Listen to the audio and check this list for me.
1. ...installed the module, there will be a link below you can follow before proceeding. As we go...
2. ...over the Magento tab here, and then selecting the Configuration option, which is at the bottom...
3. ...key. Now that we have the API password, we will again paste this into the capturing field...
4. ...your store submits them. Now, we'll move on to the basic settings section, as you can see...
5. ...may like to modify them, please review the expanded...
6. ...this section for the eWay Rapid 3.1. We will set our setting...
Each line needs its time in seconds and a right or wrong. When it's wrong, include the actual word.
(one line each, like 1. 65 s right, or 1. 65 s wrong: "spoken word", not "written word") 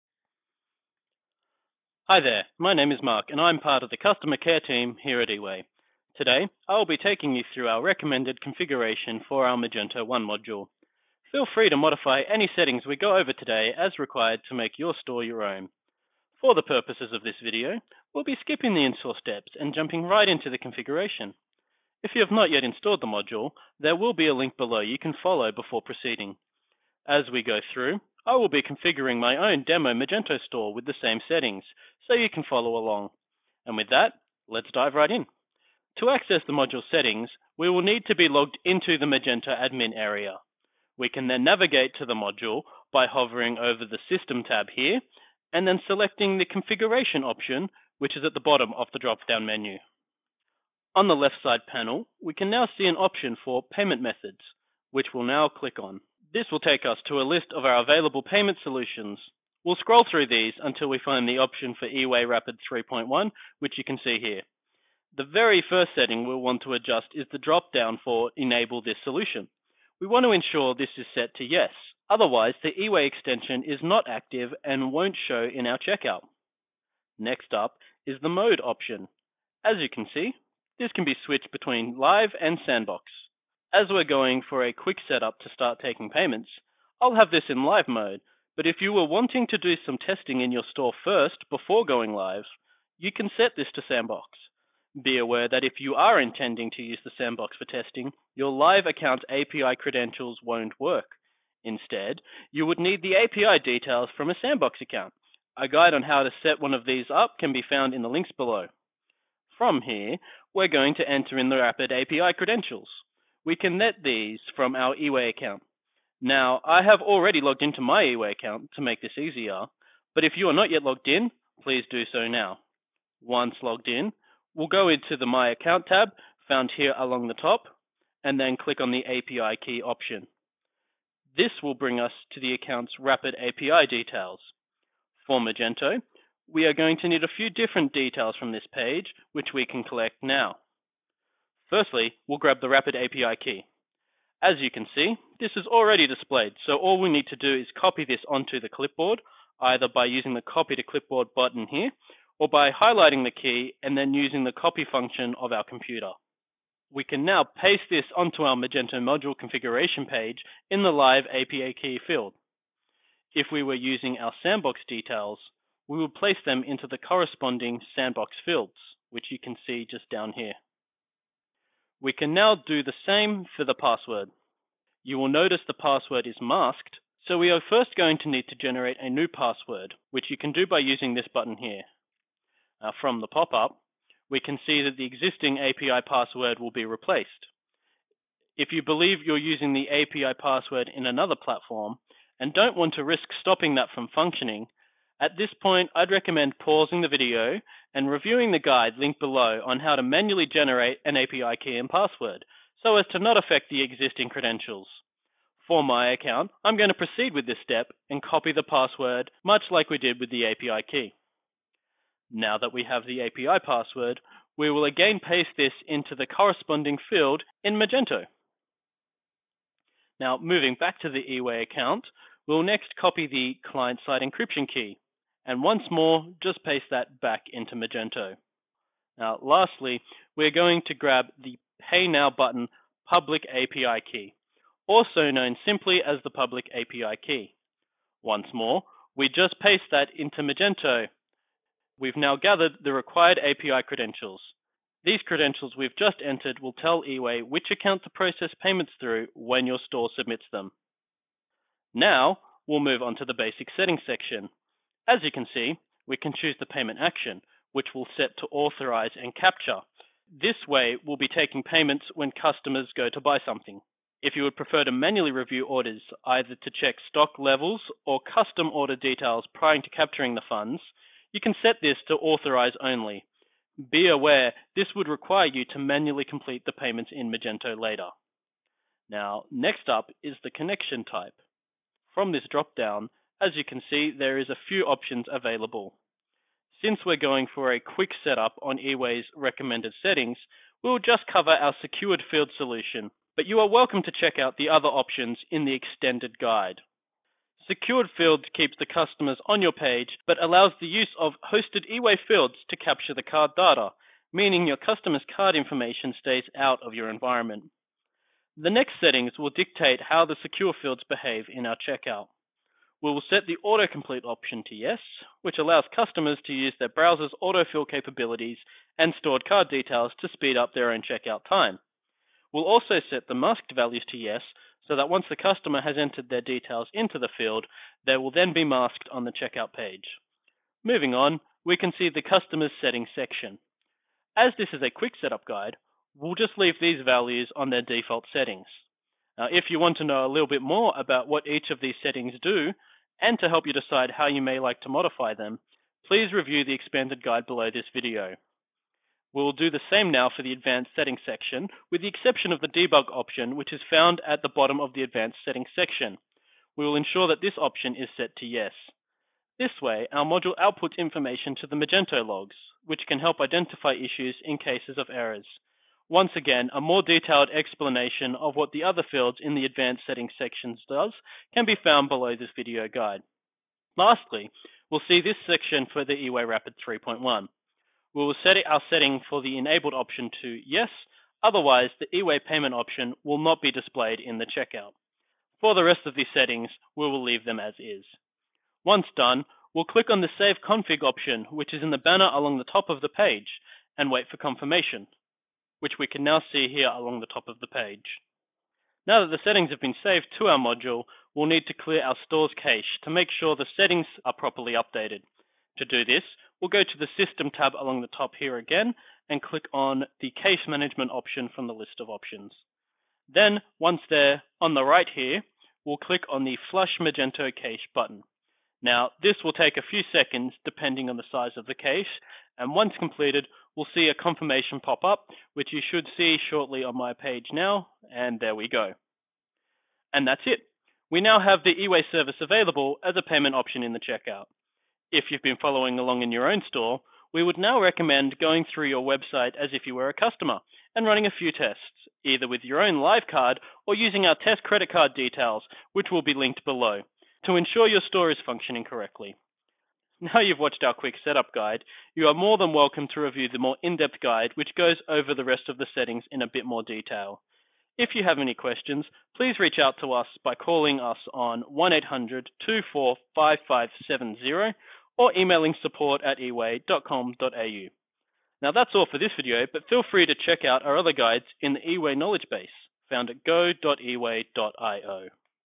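1. 22 s right
2. 43 s wrong: "System", not "Magento"
3. 210 s wrong: "corresponding", not "capturing"
4. 249 s right
5. 344 s right
6. 375 s right.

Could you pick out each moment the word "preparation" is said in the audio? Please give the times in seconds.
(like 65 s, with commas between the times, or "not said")
not said.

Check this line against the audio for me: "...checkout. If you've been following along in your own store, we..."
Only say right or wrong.
right.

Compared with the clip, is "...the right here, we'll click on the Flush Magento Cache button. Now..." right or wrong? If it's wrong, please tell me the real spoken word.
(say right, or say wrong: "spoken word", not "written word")
right.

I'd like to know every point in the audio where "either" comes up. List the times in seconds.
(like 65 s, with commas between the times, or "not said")
149 s, 266 s, 442 s.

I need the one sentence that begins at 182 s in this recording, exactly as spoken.
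from the pop-up, we can see that the existing API password will be replaced.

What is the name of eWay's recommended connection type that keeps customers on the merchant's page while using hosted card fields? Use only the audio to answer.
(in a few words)
Secured fields.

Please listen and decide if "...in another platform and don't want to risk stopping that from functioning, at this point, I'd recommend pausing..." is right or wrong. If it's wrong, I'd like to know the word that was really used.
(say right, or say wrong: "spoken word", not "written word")
right.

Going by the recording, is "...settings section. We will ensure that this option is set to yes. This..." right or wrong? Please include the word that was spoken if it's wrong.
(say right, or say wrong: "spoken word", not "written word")
right.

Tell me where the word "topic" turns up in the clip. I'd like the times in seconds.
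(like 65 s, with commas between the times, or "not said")
not said.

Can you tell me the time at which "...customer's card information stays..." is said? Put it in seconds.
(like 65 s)
304 s.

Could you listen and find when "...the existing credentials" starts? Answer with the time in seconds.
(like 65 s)
203 s.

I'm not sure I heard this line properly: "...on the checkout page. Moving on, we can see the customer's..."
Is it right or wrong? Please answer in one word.
right.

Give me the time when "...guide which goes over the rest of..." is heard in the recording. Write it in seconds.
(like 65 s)
454 s.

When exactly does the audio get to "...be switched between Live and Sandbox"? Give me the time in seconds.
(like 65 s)
81 s.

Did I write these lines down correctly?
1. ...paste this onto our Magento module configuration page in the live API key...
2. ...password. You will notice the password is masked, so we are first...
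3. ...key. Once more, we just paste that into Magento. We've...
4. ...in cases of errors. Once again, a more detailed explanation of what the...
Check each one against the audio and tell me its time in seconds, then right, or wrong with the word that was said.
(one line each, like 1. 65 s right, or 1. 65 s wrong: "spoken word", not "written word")
1. 157 s right
2. 173 s right
3. 237 s right
4. 364 s right.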